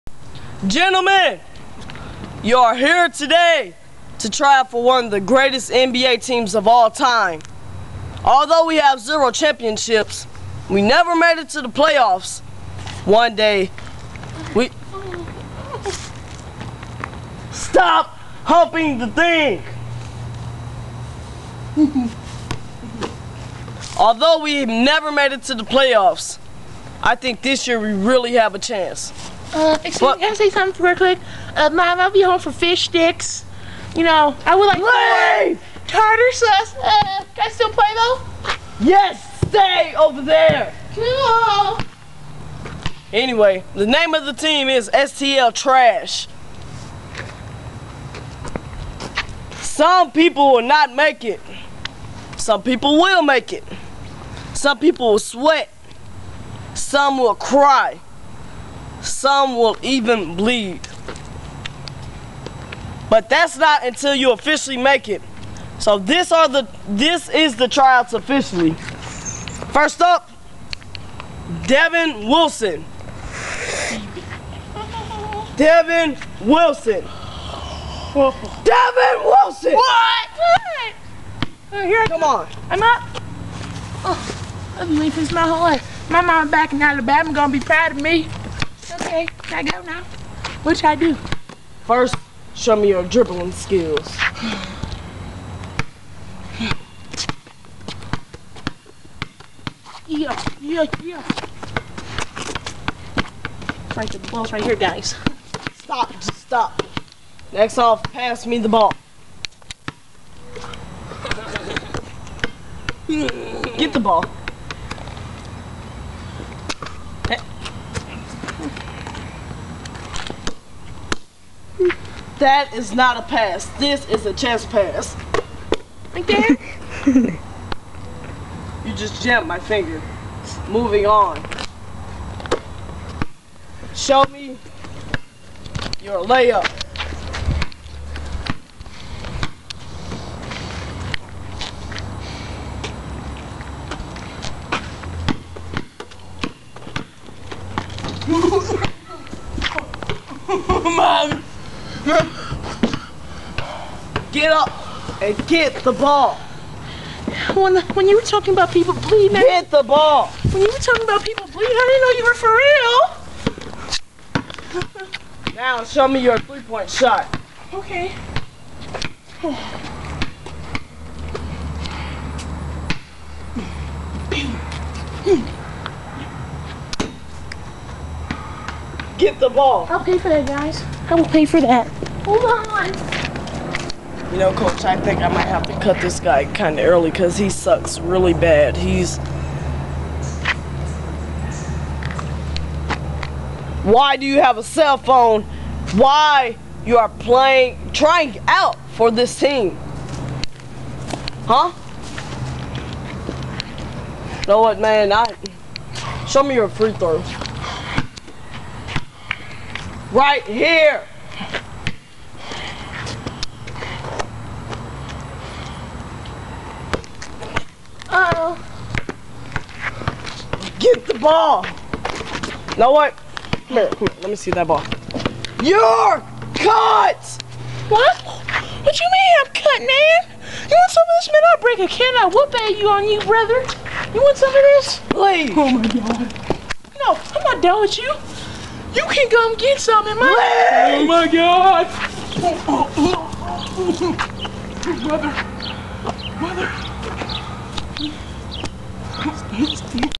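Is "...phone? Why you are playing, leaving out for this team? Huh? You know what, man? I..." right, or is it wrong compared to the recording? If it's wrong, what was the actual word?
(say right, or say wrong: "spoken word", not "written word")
wrong: "trying", not "leaving".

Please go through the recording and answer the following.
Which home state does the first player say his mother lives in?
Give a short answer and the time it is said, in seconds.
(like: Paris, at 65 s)
Alabama, at 86 s.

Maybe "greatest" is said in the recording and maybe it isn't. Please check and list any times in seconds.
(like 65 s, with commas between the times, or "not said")
5 s.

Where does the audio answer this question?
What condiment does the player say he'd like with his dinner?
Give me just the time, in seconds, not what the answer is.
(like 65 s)
35 s.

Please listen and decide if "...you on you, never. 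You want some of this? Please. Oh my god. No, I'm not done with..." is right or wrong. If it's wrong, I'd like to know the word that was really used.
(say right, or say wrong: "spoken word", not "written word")
wrong: "brother", not "never".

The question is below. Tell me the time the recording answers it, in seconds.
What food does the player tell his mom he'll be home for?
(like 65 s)
32 s.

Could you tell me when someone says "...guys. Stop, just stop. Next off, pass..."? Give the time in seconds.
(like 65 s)
104 s.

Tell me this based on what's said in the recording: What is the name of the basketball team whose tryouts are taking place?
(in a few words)
STL Trash.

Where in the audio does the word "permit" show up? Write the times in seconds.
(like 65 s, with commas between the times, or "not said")
not said.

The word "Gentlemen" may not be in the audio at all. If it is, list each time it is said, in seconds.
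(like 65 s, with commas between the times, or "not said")
0 s.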